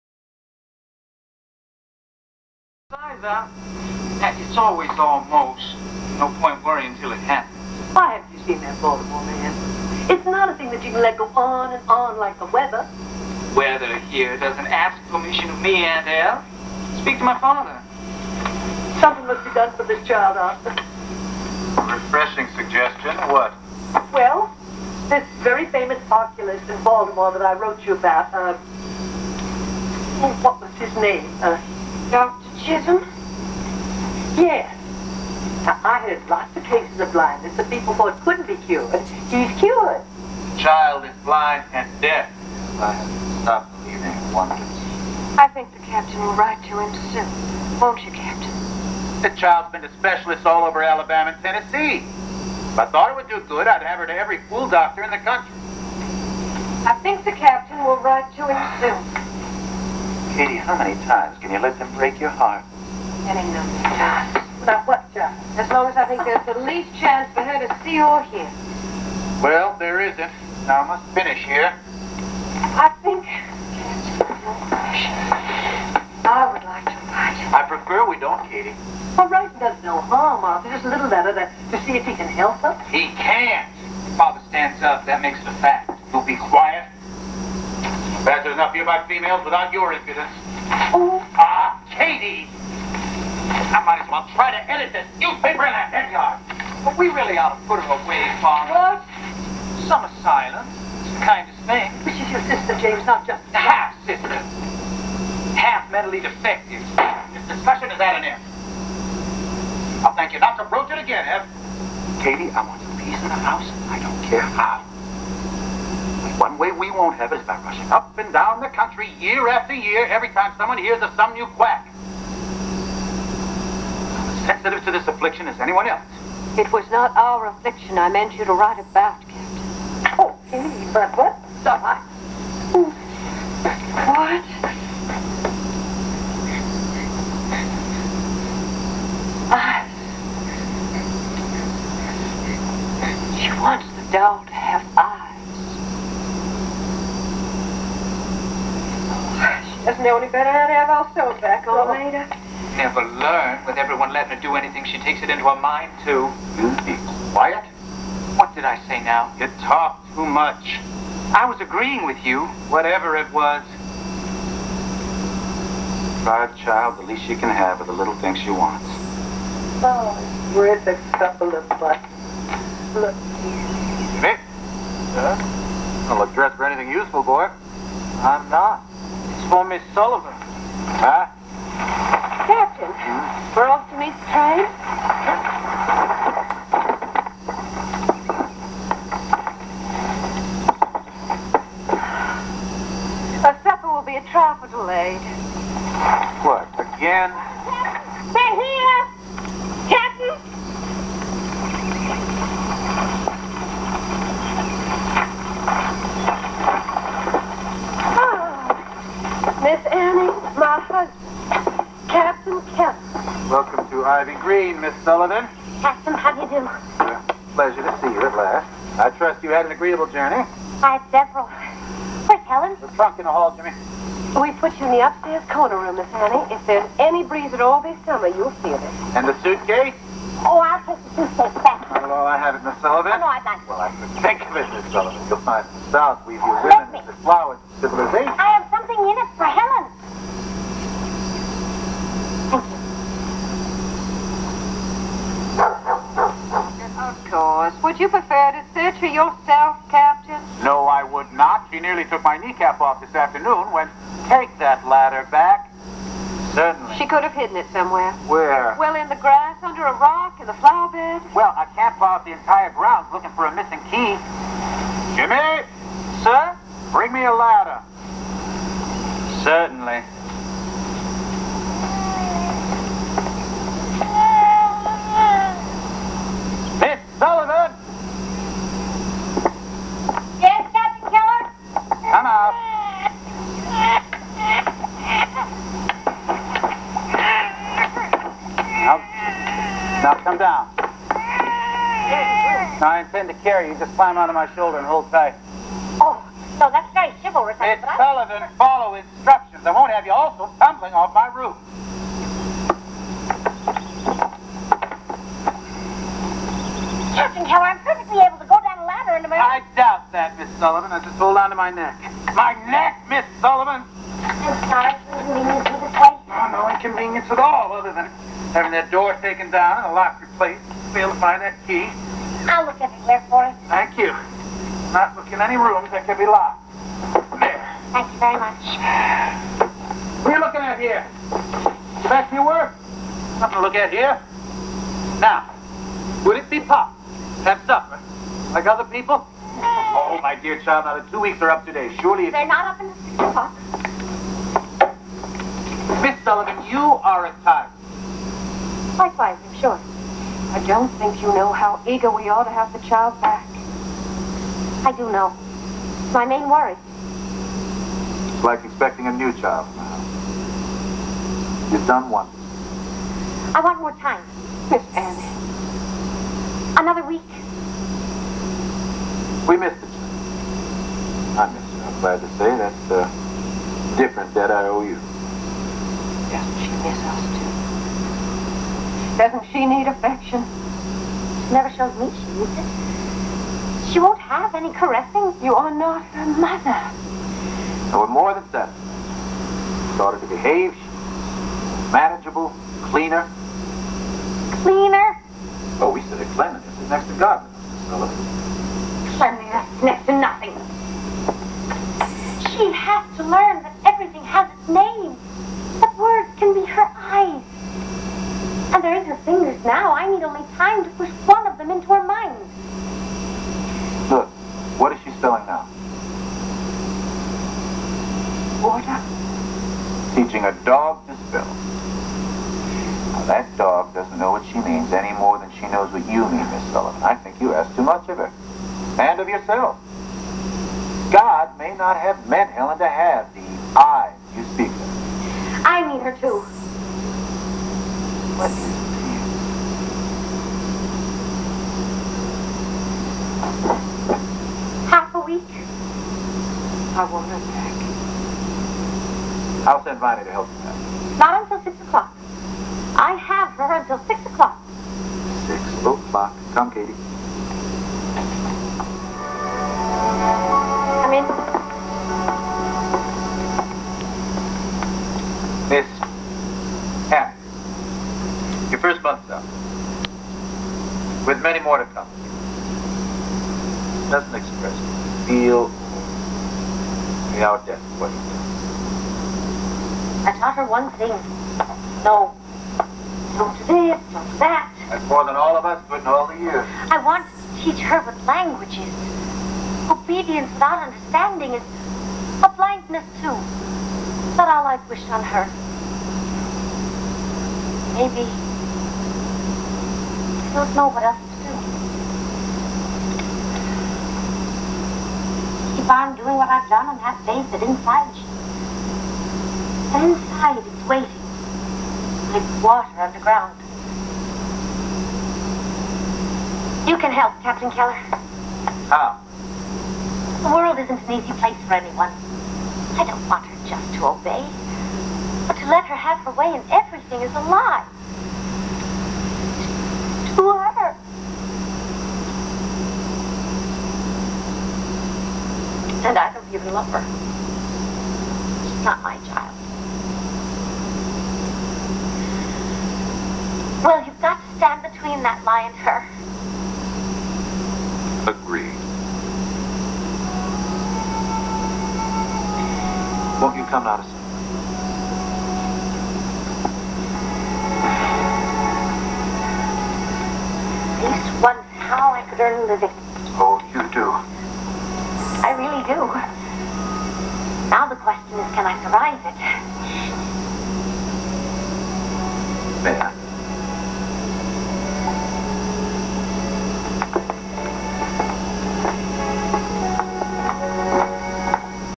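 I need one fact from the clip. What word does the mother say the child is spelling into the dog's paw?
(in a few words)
Order.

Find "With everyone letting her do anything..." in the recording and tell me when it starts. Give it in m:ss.
2:33.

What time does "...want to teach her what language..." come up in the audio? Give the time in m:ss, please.
8:07.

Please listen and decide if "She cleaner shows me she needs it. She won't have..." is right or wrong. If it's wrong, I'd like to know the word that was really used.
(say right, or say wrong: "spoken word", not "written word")
wrong: "never", not "cleaner".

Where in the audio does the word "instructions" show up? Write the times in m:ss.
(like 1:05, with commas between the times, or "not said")
4:58.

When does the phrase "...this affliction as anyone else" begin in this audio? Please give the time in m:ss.
2:04.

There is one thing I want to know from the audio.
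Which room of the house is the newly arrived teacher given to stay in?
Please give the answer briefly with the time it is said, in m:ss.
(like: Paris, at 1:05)
upstairs corner room, at 3:45.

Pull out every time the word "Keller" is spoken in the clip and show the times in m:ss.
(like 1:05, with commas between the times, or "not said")
5:07, 8:37.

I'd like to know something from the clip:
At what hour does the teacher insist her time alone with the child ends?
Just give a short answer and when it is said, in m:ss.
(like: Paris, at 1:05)
6 o'clock, at 5:42.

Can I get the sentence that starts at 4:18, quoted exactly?
Well, in the grass, under a rock, in the flower bed.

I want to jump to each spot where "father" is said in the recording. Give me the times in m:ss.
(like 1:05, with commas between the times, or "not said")
0:17, 1:24, 1:38.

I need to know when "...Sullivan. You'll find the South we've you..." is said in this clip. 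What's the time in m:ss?
3:54.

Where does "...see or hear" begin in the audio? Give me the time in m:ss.
1:07.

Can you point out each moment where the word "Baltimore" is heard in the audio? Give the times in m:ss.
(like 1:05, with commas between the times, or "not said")
0:08, 0:26.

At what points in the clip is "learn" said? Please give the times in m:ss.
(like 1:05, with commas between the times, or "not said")
2:33, 6:43.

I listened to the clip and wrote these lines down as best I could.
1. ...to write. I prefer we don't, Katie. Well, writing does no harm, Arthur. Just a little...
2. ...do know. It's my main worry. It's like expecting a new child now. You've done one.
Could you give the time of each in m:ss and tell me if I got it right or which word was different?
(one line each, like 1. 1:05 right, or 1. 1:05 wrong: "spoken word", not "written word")
1. 1:16 right
2. 5:54 right.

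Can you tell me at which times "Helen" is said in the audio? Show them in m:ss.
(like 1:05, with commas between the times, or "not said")
3:42, 3:59, 7:12.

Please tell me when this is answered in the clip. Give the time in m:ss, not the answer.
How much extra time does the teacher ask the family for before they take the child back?
6:06.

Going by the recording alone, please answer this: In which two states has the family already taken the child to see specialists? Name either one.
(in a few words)
Alabama.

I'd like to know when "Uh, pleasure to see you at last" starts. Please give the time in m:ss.
3:36.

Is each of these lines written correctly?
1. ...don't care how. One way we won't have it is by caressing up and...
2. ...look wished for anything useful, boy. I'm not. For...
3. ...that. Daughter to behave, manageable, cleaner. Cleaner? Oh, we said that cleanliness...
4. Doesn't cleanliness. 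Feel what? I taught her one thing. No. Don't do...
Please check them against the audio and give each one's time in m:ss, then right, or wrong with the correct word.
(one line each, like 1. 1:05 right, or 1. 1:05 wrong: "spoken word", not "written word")
1. 1:53 wrong: "rushing", not "caressing"
2. 2:56 wrong: "dressed", not "wished"
3. 6:28 right
4. 7:54 wrong: "express", not "cleanliness".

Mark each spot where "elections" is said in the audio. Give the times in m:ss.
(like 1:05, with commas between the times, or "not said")
not said.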